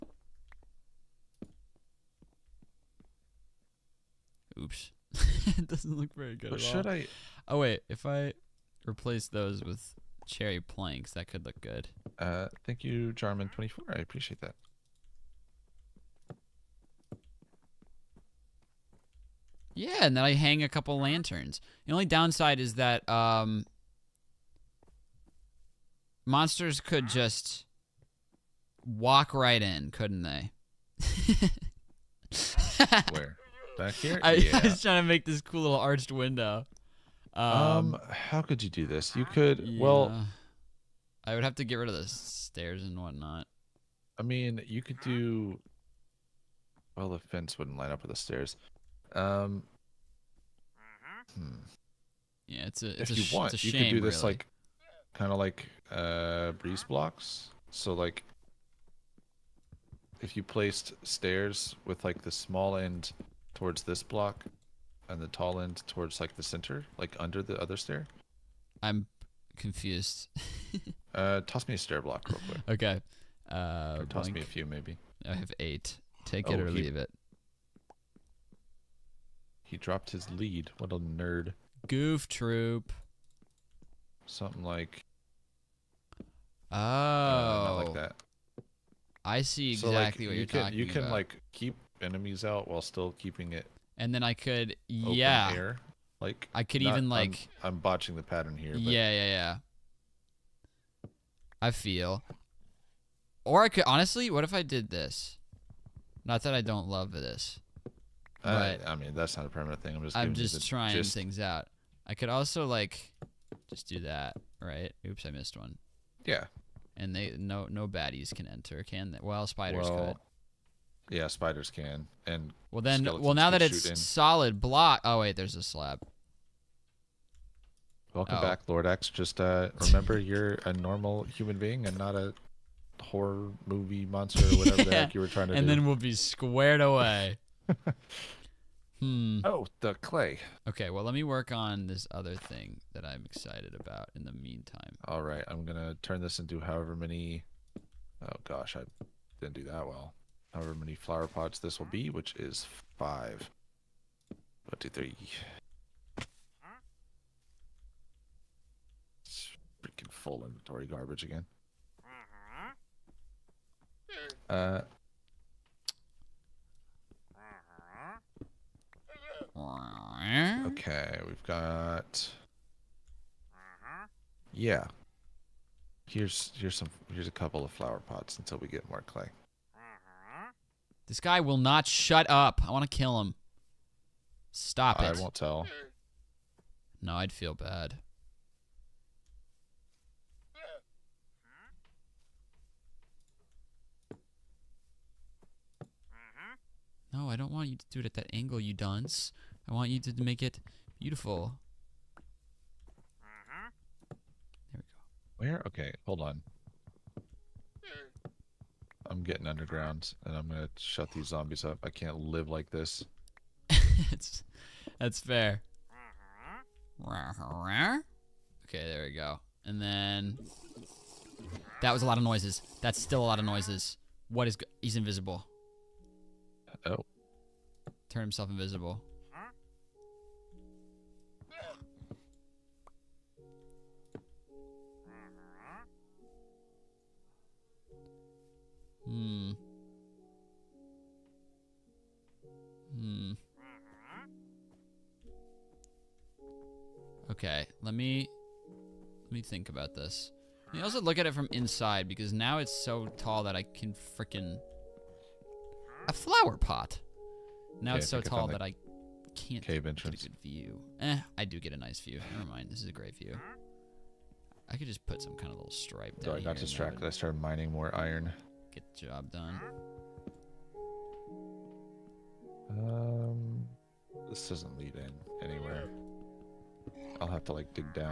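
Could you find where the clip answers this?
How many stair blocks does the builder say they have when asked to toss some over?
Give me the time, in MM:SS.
01:15.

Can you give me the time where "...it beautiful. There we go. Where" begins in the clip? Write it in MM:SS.
03:20.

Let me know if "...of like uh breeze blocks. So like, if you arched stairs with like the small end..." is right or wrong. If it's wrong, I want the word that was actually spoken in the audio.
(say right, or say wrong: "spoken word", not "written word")
wrong: "placed", not "arched".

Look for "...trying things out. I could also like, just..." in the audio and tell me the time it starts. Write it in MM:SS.
01:50.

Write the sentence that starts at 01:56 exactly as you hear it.
And they no no baddies can enter, can they?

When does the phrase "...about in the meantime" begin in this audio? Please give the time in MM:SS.
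02:23.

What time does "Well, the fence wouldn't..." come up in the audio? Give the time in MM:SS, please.
00:46.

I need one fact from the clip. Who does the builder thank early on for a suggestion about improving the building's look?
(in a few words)
Jarman24.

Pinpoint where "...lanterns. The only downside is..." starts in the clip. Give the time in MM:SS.
00:20.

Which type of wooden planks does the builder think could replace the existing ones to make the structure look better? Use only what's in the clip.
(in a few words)
cherry planks.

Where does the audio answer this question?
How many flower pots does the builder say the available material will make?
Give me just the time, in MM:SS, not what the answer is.
02:32.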